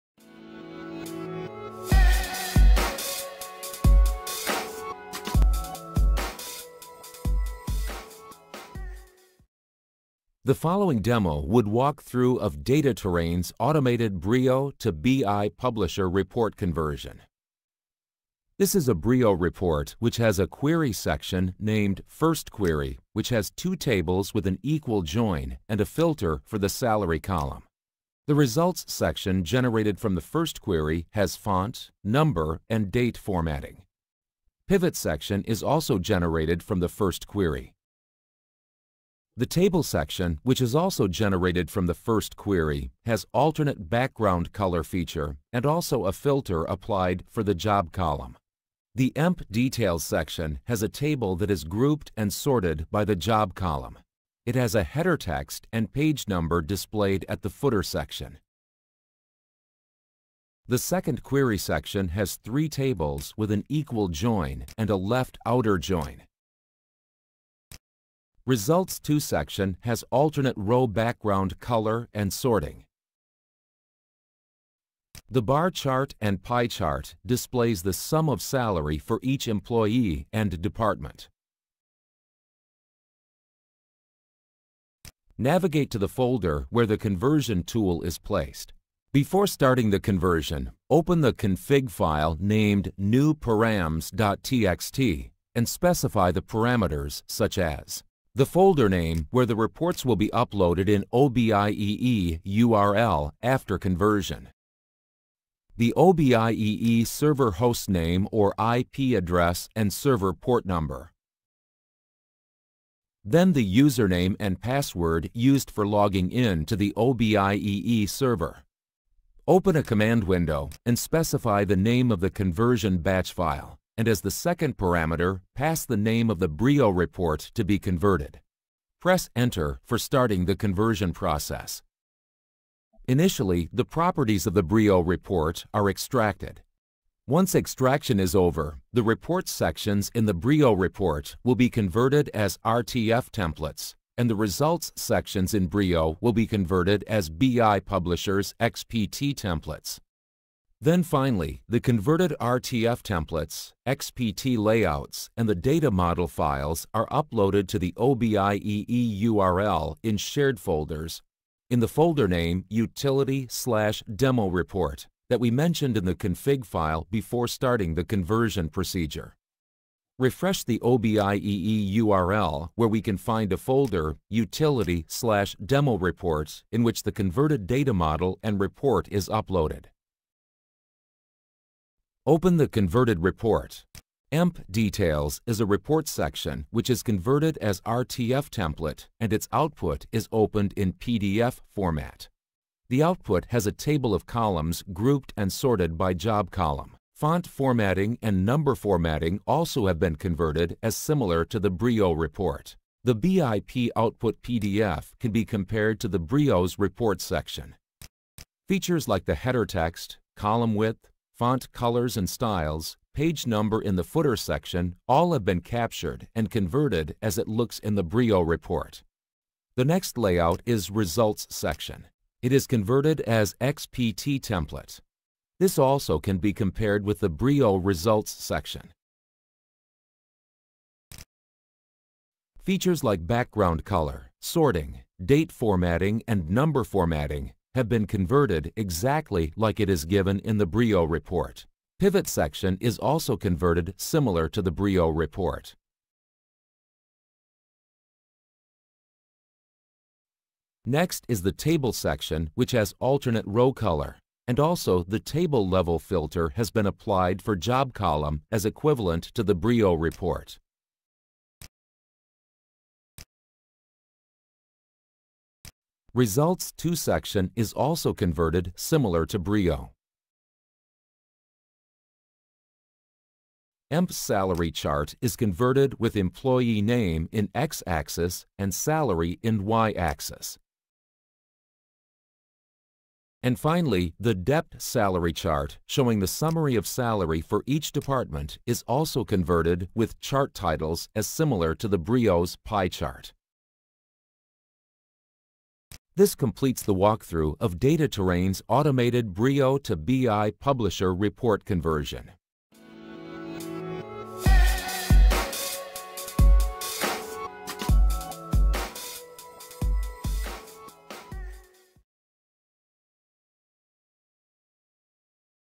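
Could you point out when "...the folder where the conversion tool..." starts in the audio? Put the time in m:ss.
1:25.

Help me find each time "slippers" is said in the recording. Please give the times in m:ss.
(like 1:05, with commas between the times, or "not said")
not said.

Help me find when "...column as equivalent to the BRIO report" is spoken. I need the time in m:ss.
4:17.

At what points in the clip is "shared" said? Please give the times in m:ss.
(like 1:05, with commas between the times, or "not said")
2:40.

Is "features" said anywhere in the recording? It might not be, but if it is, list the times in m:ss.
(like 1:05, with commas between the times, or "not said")
0:44, 3:28, 3:52.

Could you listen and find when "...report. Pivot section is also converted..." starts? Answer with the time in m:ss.
4:01.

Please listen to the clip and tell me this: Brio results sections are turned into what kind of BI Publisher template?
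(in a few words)
XPT templates.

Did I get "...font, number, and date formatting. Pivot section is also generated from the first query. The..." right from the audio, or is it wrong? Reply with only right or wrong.
right.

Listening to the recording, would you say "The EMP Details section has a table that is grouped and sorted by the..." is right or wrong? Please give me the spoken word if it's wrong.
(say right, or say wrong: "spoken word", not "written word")
right.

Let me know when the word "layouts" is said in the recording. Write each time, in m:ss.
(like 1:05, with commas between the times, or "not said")
2:34, 3:40.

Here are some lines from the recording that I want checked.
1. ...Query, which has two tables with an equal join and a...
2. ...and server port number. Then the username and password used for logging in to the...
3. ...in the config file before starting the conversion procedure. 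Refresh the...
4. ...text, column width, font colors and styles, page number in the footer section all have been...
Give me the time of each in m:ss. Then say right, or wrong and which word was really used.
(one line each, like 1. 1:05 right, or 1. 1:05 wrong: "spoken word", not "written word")
1. 0:22 right
2. 1:49 right
3. 2:45 right
4. 3:29 right.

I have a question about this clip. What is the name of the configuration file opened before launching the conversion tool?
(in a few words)
newparams.txt.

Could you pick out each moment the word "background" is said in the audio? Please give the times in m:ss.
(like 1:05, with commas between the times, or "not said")
0:43, 1:10, 3:53.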